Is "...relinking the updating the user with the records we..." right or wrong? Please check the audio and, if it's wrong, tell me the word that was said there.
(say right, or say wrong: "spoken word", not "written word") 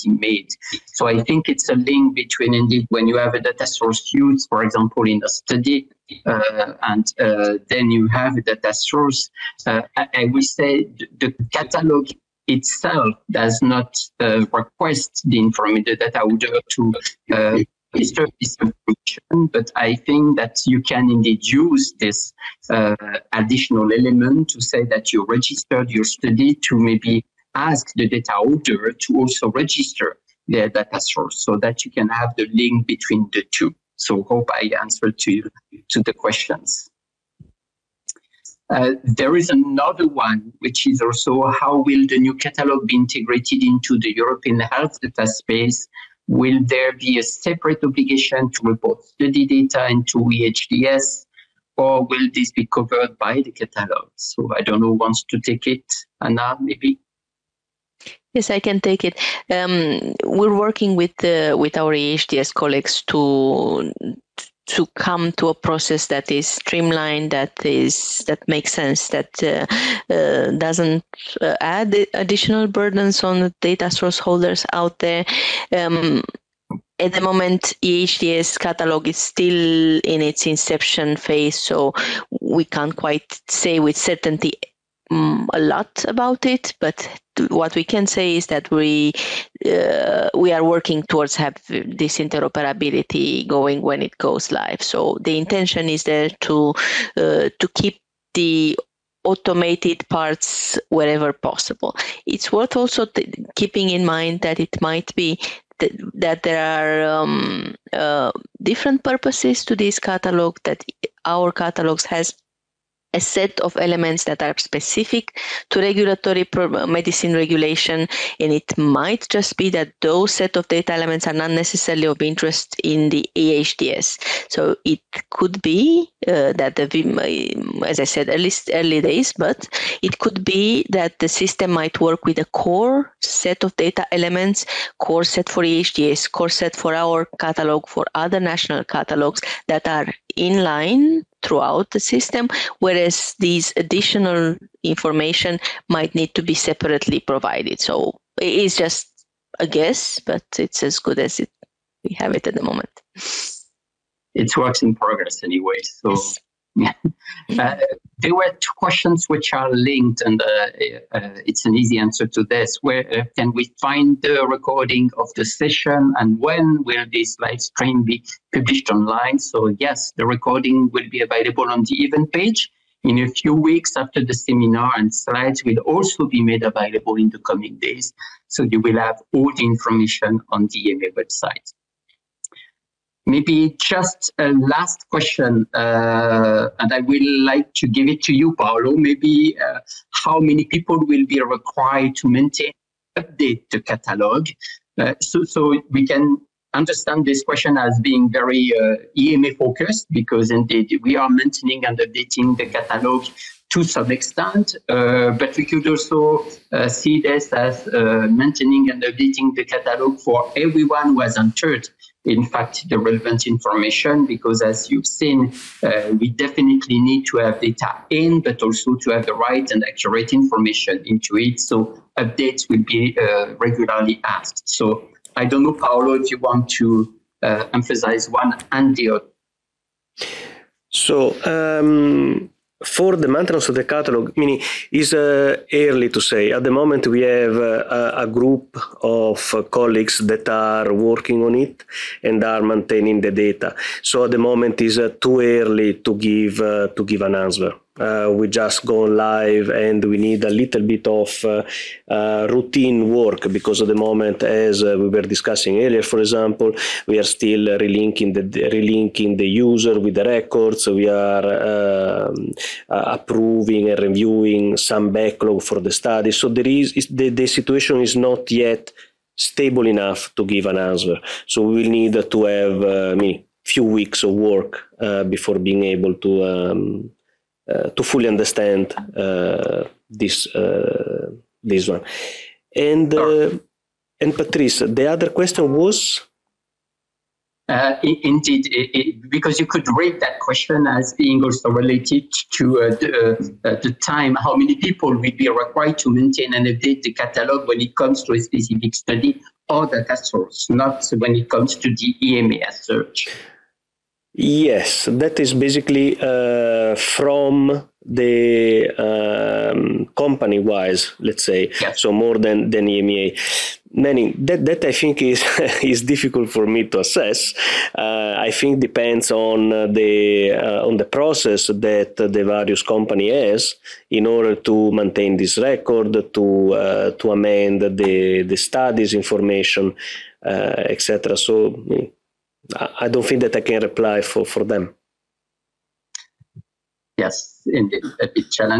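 wrong: "relinking", not "updating".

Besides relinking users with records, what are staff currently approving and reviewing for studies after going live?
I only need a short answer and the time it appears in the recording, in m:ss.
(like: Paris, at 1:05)
Backlog, at 4:25.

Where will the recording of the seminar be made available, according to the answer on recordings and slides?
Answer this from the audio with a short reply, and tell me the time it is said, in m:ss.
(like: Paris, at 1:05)
The event page, at 2:52.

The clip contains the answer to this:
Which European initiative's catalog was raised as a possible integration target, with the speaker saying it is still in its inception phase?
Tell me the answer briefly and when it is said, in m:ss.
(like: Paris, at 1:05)
European health data space, at 0:44.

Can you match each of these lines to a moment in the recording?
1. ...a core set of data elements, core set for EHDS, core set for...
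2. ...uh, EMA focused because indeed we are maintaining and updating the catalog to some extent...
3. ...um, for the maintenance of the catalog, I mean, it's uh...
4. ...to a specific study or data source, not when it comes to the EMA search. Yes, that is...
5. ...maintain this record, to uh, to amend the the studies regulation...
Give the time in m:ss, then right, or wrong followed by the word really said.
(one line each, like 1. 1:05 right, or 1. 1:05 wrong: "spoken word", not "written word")
1. 2:12 right
2. 3:18 right
3. 3:51 right
4. 4:58 right
5. 5:24 wrong: "information", not "regulation".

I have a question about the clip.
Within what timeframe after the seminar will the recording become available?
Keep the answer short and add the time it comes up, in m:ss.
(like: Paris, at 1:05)
A few weeks, at 2:53.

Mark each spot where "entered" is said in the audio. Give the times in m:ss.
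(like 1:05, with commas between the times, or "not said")
3:31.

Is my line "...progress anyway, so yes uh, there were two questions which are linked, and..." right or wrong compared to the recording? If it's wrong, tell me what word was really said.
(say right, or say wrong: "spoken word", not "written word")
right.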